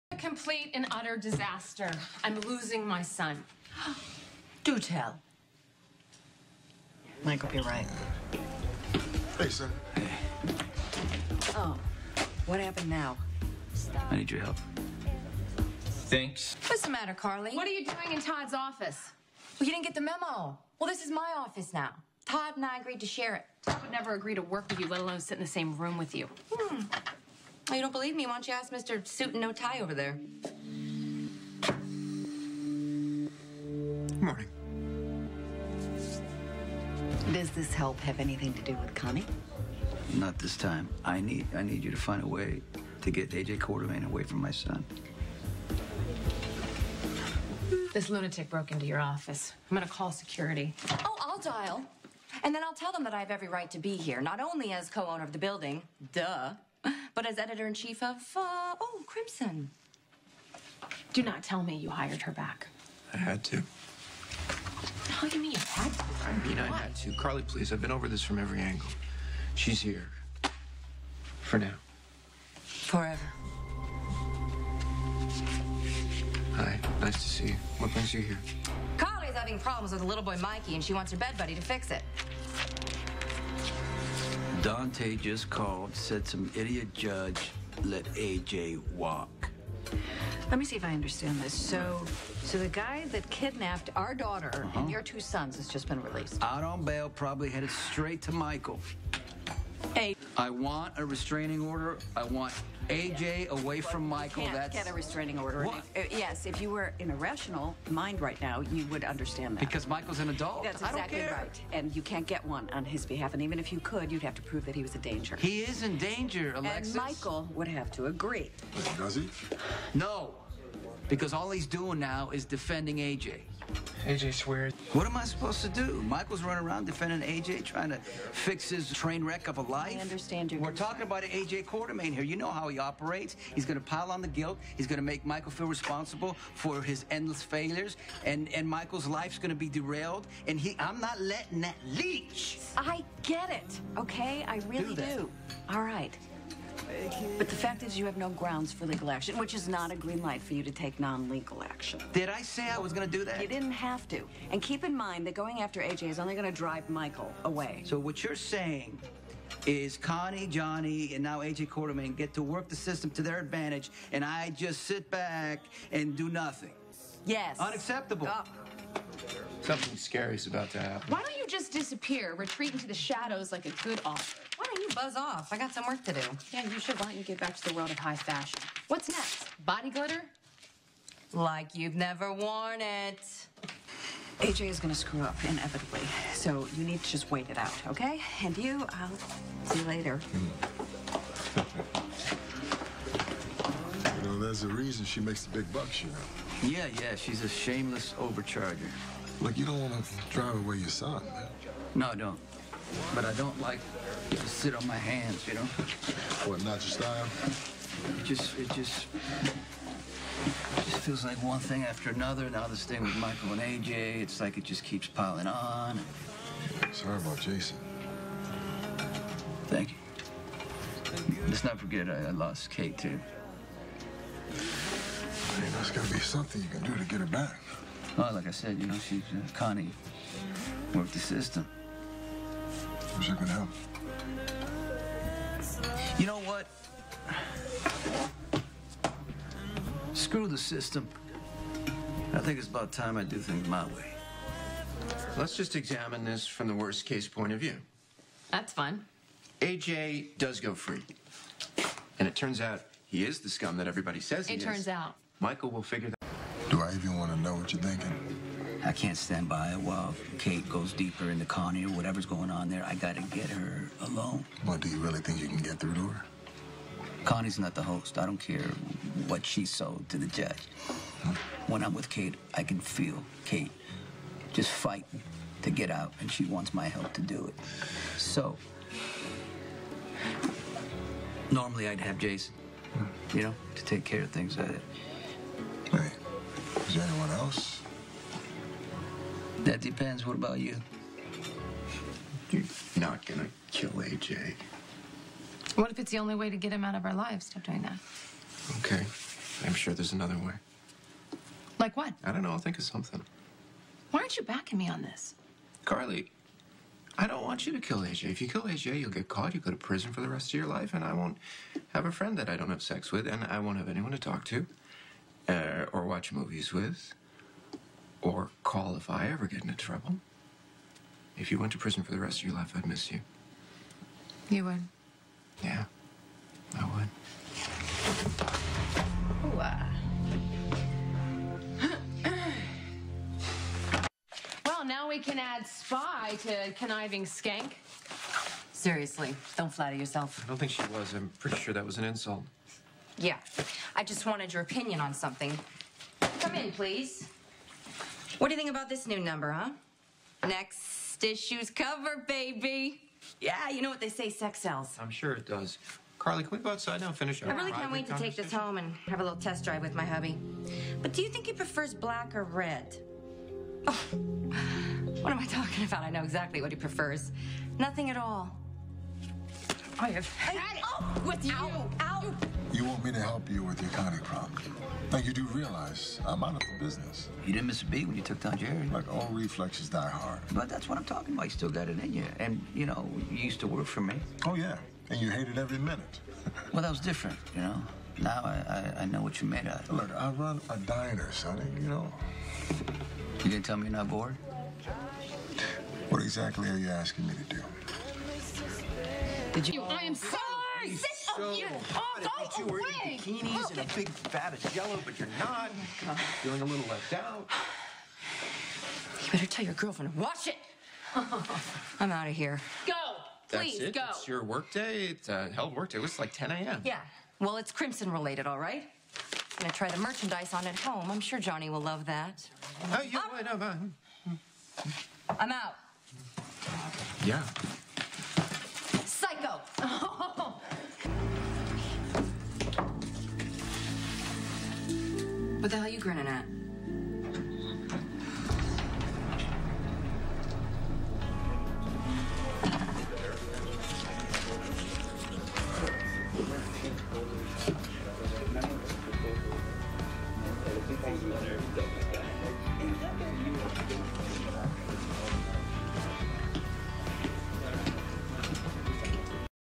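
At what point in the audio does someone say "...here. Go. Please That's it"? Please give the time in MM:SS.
06:52.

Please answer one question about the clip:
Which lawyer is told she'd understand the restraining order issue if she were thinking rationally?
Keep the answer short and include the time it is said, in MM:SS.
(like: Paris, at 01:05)
Alexis, at 01:56.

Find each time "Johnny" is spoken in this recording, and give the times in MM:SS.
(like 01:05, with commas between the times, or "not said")
02:40, 07:01.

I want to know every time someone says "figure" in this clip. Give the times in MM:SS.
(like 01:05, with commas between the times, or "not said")
04:15.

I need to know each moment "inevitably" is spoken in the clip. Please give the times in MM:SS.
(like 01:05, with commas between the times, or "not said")
03:05.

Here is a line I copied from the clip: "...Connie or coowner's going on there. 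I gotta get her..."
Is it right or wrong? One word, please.
wrong.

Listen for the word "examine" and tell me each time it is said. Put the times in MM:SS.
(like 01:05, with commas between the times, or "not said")
04:05.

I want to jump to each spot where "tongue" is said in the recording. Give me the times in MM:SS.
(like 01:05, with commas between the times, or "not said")
not said.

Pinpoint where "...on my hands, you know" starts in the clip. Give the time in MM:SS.
03:24.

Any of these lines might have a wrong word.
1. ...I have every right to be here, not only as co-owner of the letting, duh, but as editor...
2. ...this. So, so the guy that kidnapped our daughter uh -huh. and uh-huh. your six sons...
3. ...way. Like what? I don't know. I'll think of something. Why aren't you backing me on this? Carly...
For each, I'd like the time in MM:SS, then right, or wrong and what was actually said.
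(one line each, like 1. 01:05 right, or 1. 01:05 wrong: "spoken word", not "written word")
1. 00:53 wrong: "building", not "letting"
2. 01:31 wrong: "two", not "six"
3. 05:00 right.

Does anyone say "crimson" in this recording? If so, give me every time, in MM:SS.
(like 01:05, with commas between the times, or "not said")
00:59, 06:57.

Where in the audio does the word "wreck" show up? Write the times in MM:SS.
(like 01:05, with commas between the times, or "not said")
02:09.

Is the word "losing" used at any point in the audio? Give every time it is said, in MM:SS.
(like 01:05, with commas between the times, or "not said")
00:02.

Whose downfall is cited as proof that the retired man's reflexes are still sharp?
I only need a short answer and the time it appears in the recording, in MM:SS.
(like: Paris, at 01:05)
Jerry, at 06:18.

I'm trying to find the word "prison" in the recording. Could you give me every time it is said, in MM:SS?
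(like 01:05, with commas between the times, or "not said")
05:09, 05:21.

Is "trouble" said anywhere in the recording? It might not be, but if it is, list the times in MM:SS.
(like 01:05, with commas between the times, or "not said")
05:19.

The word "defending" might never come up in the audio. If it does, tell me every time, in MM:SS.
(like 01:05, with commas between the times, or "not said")
02:02, 02:06.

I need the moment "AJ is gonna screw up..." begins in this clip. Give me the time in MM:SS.
03:04.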